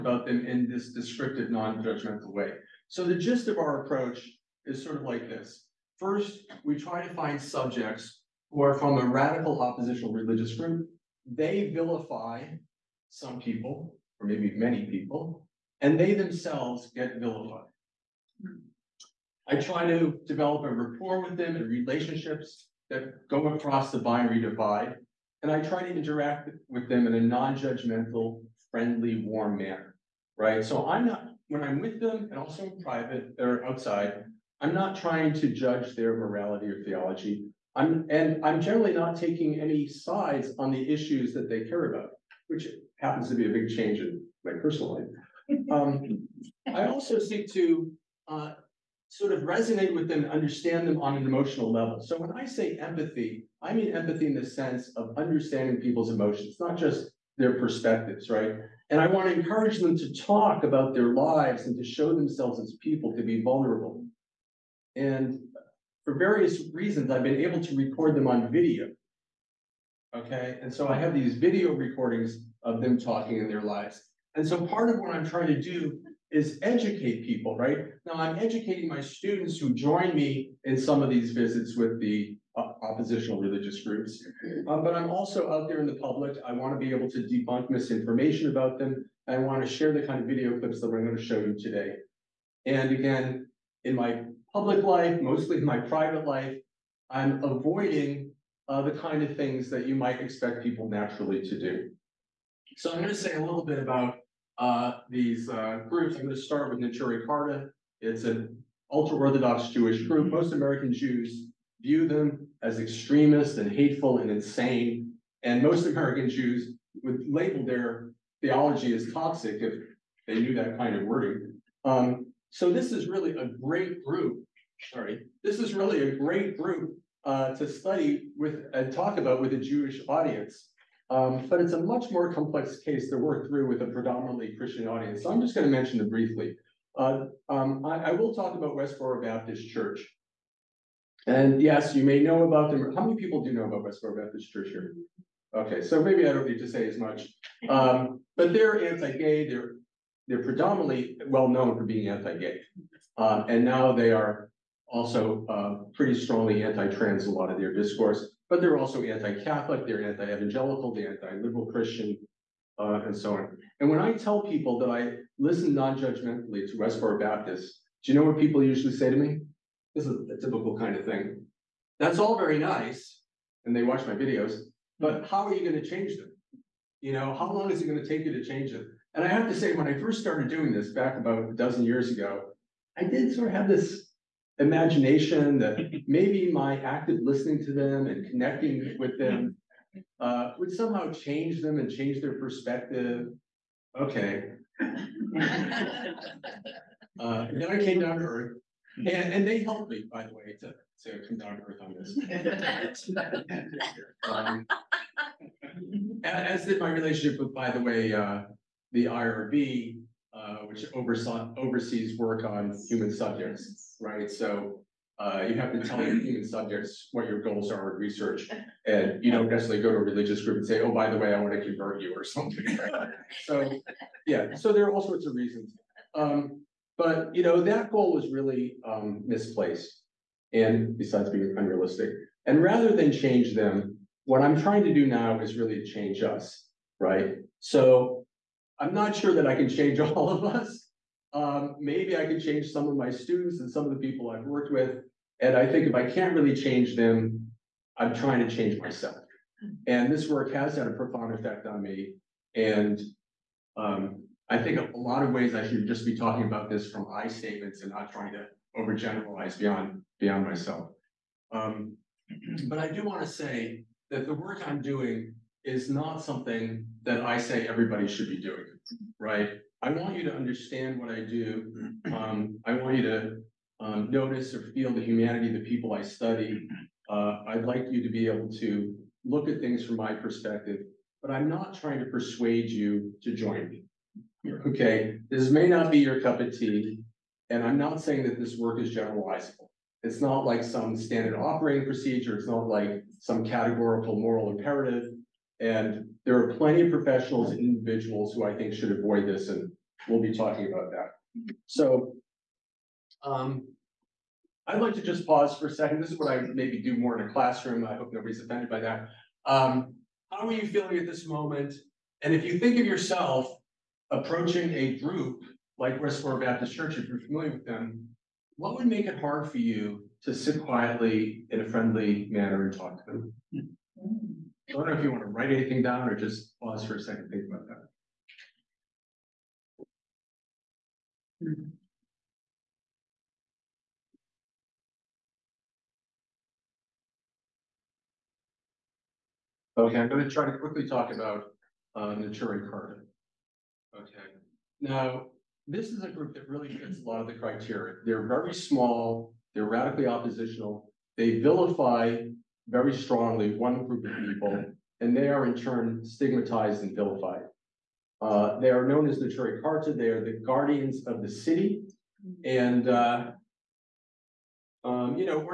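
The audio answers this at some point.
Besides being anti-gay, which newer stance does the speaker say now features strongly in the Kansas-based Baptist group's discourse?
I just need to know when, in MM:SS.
02:36.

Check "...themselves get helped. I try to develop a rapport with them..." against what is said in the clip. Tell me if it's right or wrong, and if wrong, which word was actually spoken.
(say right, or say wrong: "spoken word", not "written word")
wrong: "vilified", not "helped".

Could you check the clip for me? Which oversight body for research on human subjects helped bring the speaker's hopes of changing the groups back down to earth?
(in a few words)
the IRB.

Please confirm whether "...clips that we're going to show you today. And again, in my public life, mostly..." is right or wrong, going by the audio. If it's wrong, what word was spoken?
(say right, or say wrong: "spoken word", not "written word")
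right.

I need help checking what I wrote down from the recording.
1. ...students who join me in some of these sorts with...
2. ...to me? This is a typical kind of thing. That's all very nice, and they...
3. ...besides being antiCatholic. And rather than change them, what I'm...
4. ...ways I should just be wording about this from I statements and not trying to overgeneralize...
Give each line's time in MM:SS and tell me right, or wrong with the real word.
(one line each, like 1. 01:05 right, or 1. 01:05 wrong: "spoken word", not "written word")
1. 01:19 wrong: "visits", not "sorts"
2. 02:49 right
3. 03:50 wrong: "unrealistic", not "antiCatholic"
4. 04:15 wrong: "talking", not "wording".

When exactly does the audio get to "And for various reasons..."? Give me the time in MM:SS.
01:04.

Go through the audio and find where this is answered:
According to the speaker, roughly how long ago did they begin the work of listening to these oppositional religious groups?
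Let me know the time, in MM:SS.
03:01.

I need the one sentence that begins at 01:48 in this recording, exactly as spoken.
It's an ultra Orthodox Jewish group.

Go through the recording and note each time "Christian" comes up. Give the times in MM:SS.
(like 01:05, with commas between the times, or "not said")
02:14, 02:41.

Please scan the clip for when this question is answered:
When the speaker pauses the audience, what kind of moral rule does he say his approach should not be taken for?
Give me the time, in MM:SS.
04:53.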